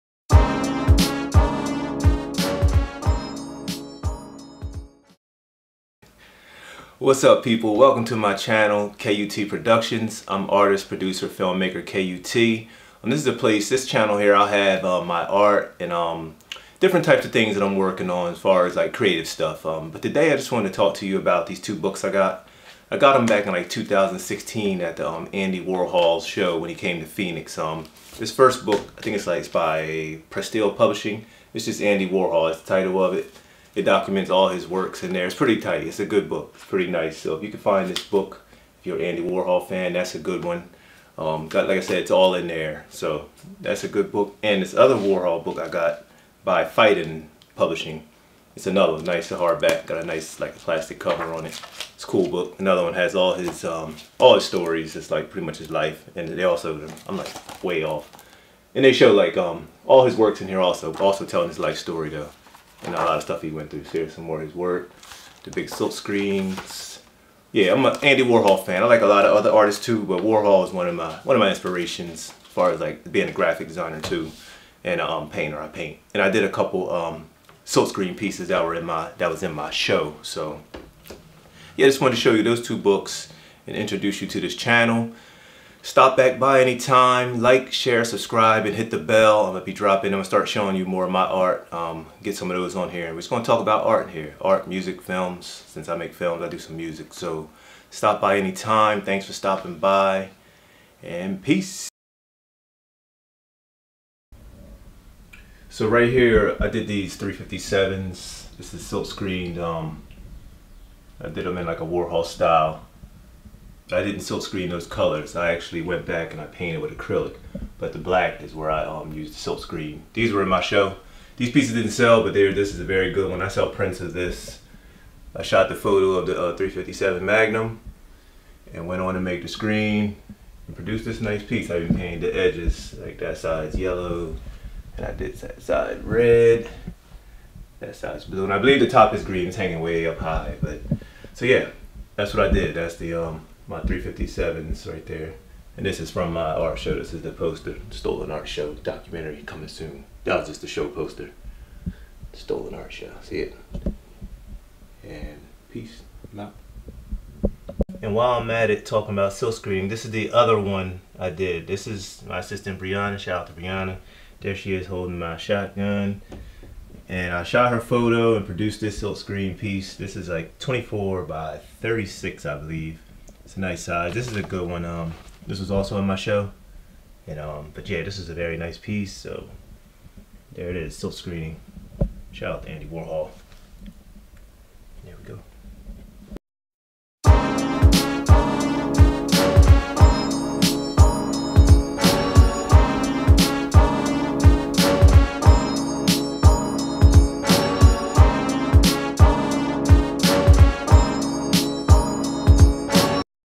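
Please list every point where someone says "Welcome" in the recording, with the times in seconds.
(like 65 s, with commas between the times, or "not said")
7 s.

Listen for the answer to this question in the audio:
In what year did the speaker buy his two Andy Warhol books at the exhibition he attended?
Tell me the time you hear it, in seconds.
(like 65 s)
23 s.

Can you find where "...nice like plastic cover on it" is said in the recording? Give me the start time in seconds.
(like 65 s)
50 s.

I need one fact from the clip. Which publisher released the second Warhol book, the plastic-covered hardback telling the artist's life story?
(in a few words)
Phaidon Publishing.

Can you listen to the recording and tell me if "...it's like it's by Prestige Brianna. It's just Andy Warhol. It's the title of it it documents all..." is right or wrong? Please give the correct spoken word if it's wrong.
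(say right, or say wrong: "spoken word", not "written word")
wrong: "Publishing", not "Brianna".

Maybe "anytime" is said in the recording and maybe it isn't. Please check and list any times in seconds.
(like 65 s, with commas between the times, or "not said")
86 s, 98 s.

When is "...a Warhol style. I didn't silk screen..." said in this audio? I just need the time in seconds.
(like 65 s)
111 s.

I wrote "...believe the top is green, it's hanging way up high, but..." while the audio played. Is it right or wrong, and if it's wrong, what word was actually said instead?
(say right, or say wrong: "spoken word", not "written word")
right.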